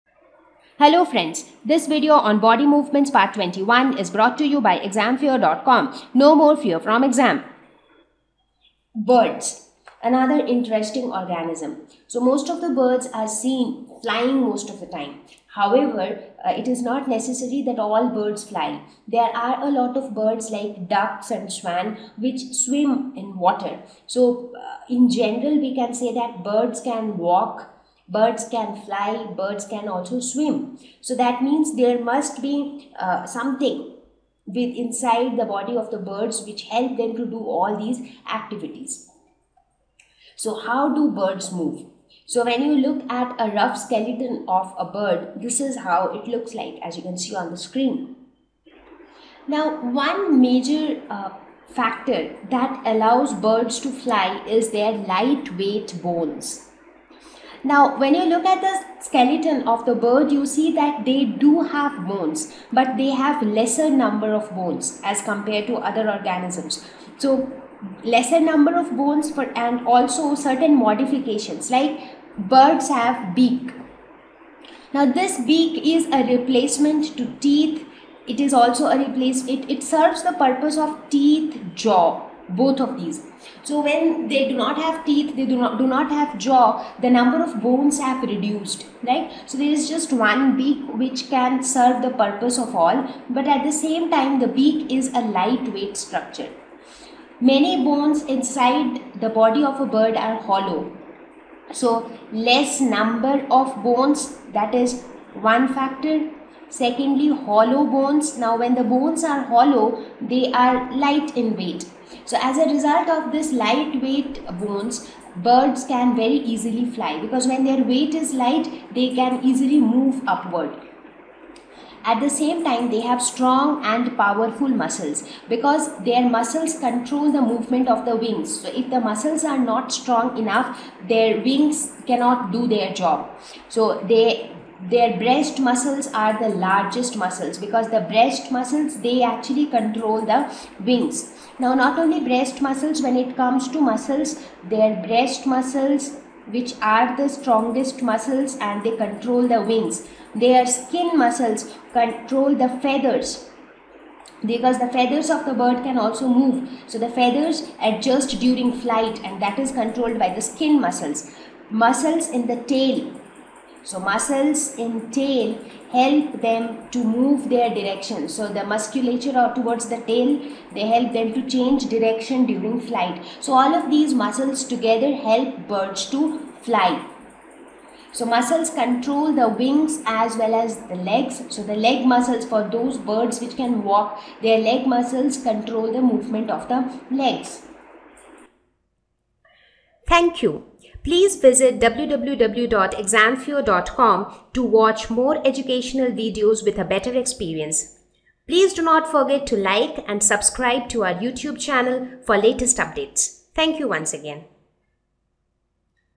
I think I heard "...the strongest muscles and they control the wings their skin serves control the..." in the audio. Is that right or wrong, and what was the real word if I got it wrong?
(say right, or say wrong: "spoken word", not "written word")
wrong: "muscles", not "serves".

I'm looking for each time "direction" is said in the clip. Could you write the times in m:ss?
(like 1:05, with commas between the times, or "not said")
2:47, 2:51.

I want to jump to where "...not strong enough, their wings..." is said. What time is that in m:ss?
2:09.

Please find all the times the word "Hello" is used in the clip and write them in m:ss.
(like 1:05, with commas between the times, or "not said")
0:00.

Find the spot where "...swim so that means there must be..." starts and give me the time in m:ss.
0:30.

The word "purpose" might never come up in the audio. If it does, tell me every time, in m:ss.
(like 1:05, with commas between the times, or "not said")
1:20, 1:32.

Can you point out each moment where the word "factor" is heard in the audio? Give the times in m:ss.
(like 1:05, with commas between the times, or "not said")
0:51, 1:45.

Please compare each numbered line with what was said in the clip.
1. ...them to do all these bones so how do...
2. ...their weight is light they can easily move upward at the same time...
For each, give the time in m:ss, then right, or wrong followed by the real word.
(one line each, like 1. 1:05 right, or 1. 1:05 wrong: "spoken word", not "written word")
1. 0:36 wrong: "activities", not "bones"
2. 1:57 right.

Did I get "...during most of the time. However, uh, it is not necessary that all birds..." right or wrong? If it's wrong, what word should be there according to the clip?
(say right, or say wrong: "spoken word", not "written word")
wrong: "flying", not "during".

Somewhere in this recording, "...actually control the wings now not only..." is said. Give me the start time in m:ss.
2:19.